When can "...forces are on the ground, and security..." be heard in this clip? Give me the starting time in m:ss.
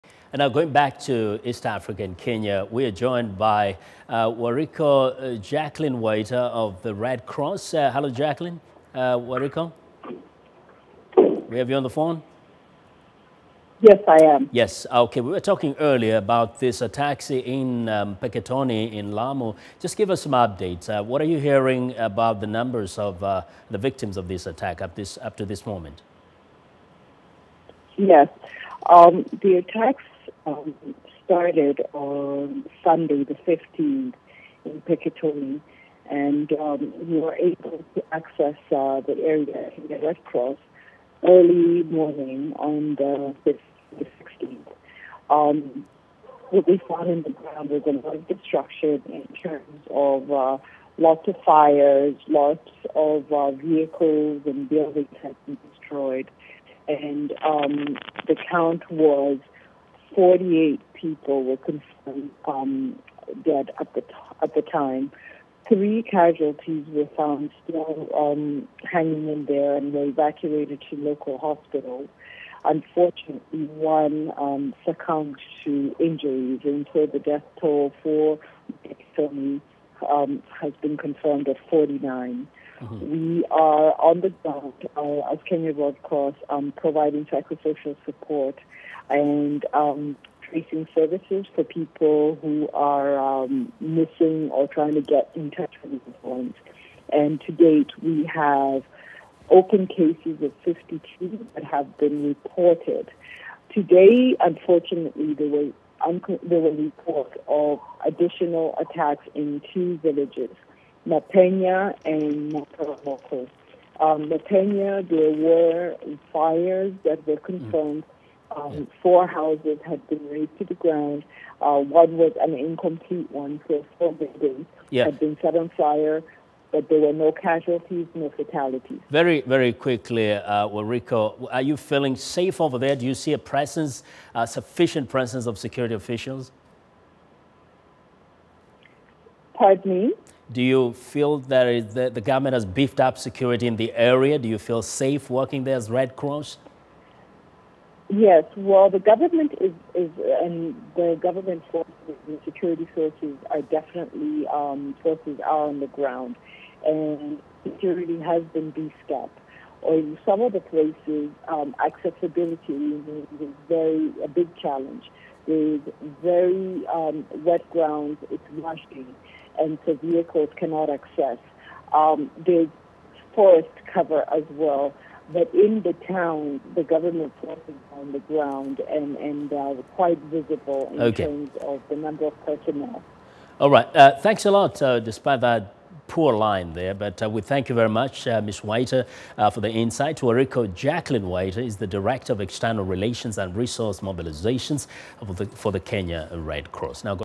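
2:35.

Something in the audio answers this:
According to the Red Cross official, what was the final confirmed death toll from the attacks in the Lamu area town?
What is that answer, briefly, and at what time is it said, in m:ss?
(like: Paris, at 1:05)
49, at 1:21.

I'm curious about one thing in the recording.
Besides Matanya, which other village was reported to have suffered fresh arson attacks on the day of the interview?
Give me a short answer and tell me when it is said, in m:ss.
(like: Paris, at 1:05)
Mataromoko, at 1:52.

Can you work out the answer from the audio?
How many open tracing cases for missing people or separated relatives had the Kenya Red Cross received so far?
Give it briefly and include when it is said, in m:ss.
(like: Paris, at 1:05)
52, at 1:40.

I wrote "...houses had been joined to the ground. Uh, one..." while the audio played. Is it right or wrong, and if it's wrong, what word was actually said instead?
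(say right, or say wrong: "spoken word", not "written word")
wrong: "razed", not "joined".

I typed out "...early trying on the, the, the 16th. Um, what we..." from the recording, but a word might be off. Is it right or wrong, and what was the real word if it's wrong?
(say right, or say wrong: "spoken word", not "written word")
wrong: "morning", not "trying".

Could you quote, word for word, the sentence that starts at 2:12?
Do you see a presence, uh, sufficient presence of security officials?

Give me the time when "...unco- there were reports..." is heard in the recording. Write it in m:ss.
1:46.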